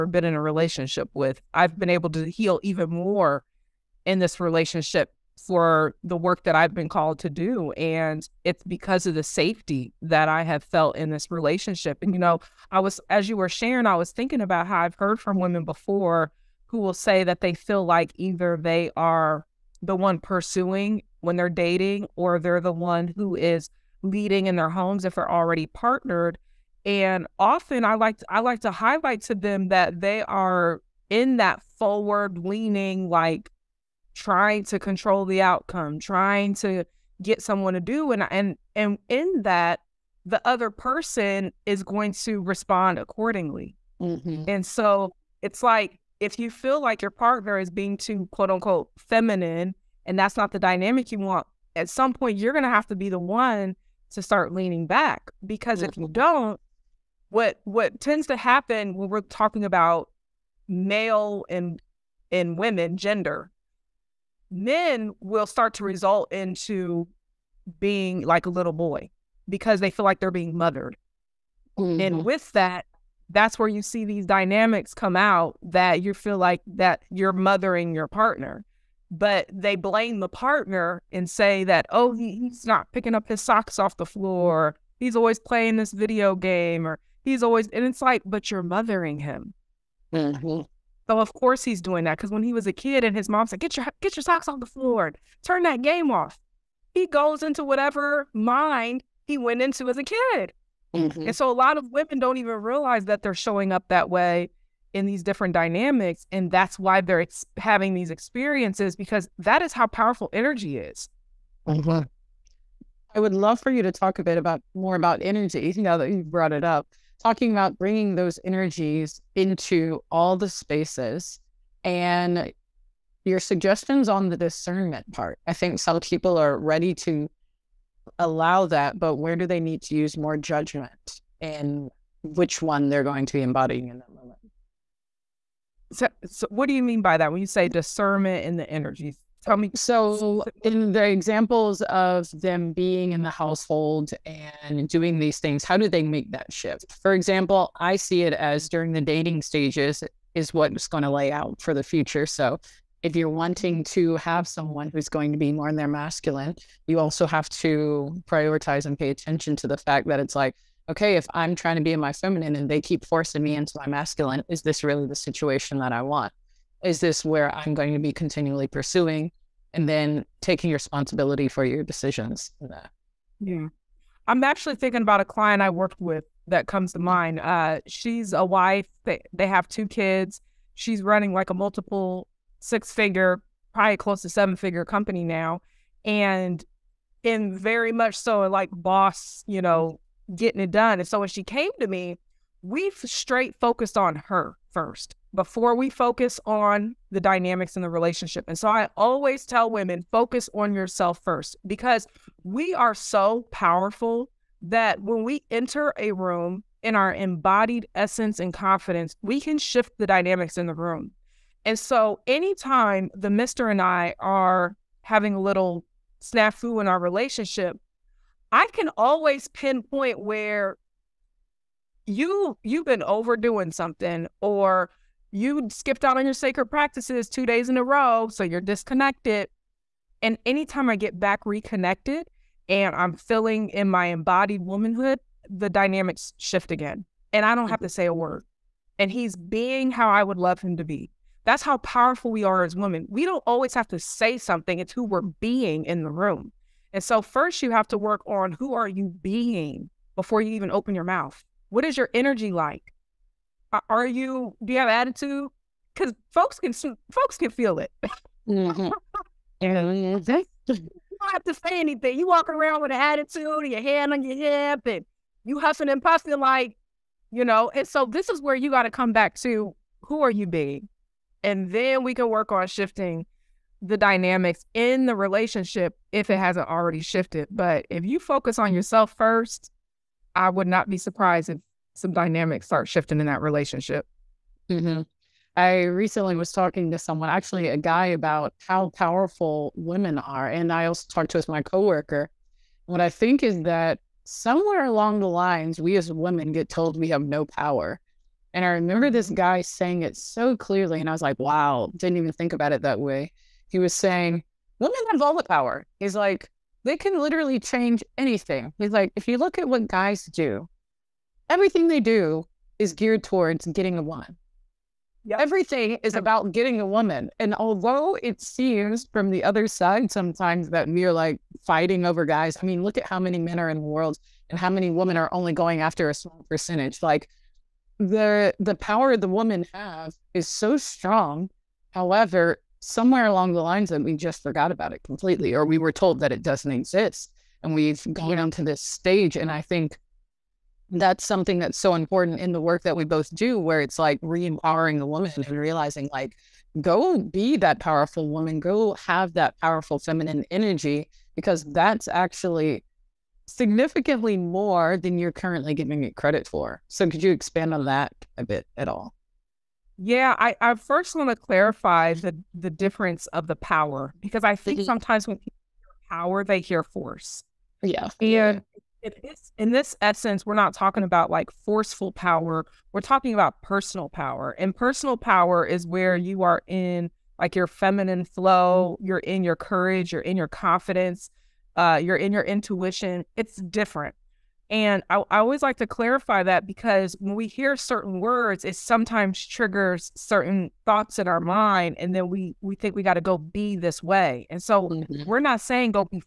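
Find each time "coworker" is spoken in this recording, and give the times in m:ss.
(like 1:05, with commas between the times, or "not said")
4:51.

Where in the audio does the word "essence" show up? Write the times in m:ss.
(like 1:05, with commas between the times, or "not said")
3:27, 6:10.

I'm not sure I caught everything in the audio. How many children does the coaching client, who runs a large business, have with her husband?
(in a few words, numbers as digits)
2.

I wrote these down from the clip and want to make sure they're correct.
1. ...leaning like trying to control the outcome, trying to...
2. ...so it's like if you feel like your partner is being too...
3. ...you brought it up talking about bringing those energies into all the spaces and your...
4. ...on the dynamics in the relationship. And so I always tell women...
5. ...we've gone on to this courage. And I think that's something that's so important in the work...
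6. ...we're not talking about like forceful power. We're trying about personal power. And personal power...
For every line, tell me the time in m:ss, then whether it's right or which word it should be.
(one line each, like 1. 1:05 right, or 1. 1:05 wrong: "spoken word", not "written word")
1. 0:32 right
2. 0:44 right
3. 1:56 right
4. 3:16 right
5. 5:37 wrong: "stage", not "courage"
6. 6:10 wrong: "talking", not "trying".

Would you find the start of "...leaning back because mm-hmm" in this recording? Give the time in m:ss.
0:54.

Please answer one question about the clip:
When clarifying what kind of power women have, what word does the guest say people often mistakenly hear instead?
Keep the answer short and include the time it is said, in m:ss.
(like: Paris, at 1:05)
Force, at 6:06.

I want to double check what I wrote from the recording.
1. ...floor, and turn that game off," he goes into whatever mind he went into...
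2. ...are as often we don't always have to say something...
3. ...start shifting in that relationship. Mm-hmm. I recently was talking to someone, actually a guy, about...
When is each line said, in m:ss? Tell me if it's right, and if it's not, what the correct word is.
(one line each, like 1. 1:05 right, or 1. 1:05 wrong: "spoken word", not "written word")
1. 1:34 right
2. 4:02 wrong: "women", not "often"
3. 4:42 right.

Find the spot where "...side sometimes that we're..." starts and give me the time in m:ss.
5:19.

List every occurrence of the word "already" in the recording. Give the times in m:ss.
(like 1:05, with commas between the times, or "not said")
0:25, 4:36.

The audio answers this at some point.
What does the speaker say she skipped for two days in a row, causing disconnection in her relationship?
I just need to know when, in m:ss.
3:46.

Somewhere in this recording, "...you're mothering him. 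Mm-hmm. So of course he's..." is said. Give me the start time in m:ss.
1:28.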